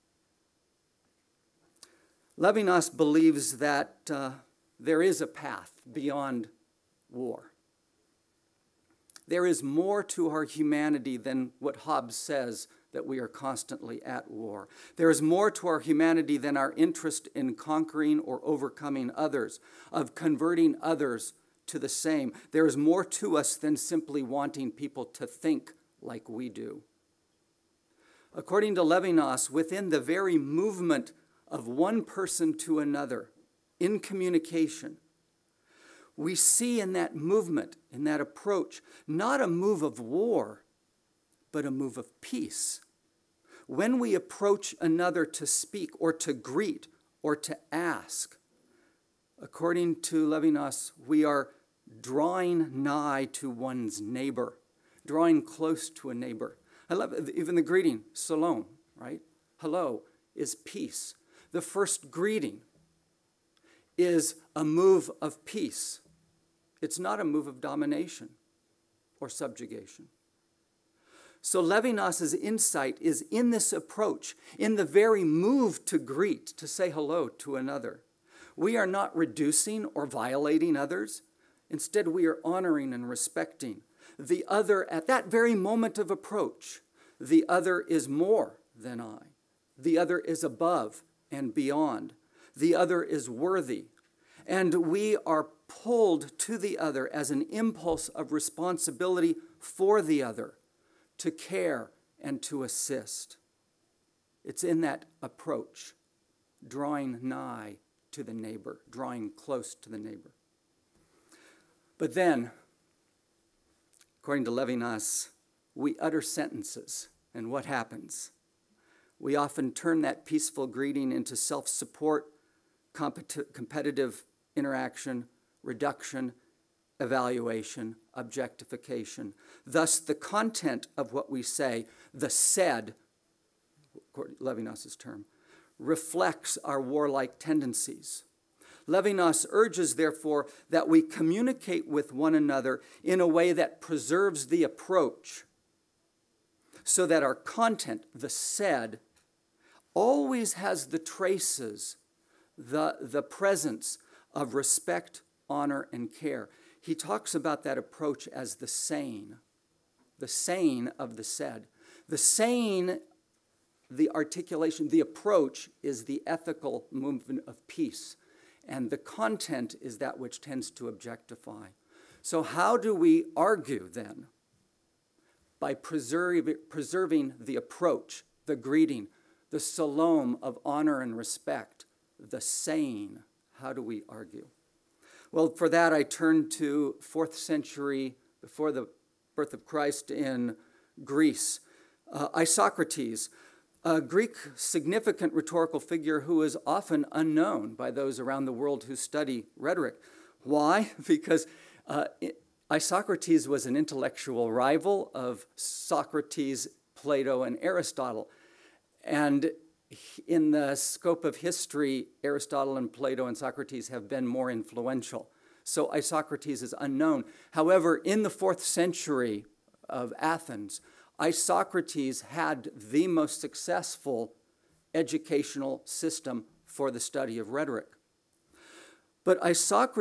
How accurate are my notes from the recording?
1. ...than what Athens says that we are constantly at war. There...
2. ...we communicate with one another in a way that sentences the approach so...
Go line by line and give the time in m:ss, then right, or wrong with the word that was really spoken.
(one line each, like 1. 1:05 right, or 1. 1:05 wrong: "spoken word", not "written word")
1. 0:11 wrong: "Hobbes", not "Athens"
2. 2:20 wrong: "preserves", not "sentences".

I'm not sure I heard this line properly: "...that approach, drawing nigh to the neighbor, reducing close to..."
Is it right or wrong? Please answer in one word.
wrong.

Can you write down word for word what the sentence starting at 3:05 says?
Well, for that, I turn to fourth century before the birth of Christ in Greece.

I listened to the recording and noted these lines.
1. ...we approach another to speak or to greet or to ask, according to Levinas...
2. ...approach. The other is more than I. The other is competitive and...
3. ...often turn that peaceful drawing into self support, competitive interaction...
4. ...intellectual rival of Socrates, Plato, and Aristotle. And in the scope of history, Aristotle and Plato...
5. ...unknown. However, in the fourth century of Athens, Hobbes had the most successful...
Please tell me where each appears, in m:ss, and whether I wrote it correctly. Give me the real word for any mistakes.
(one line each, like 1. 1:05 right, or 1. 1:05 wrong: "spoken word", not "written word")
1. 0:43 right
2. 1:26 wrong: "above", not "competitive"
3. 1:59 wrong: "greeting", not "drawing"
4. 3:23 right
5. 3:36 wrong: "Isocrates", not "Hobbes".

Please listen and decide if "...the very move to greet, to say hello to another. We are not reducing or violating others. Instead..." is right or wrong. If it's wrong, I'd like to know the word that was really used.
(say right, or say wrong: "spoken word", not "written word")
right.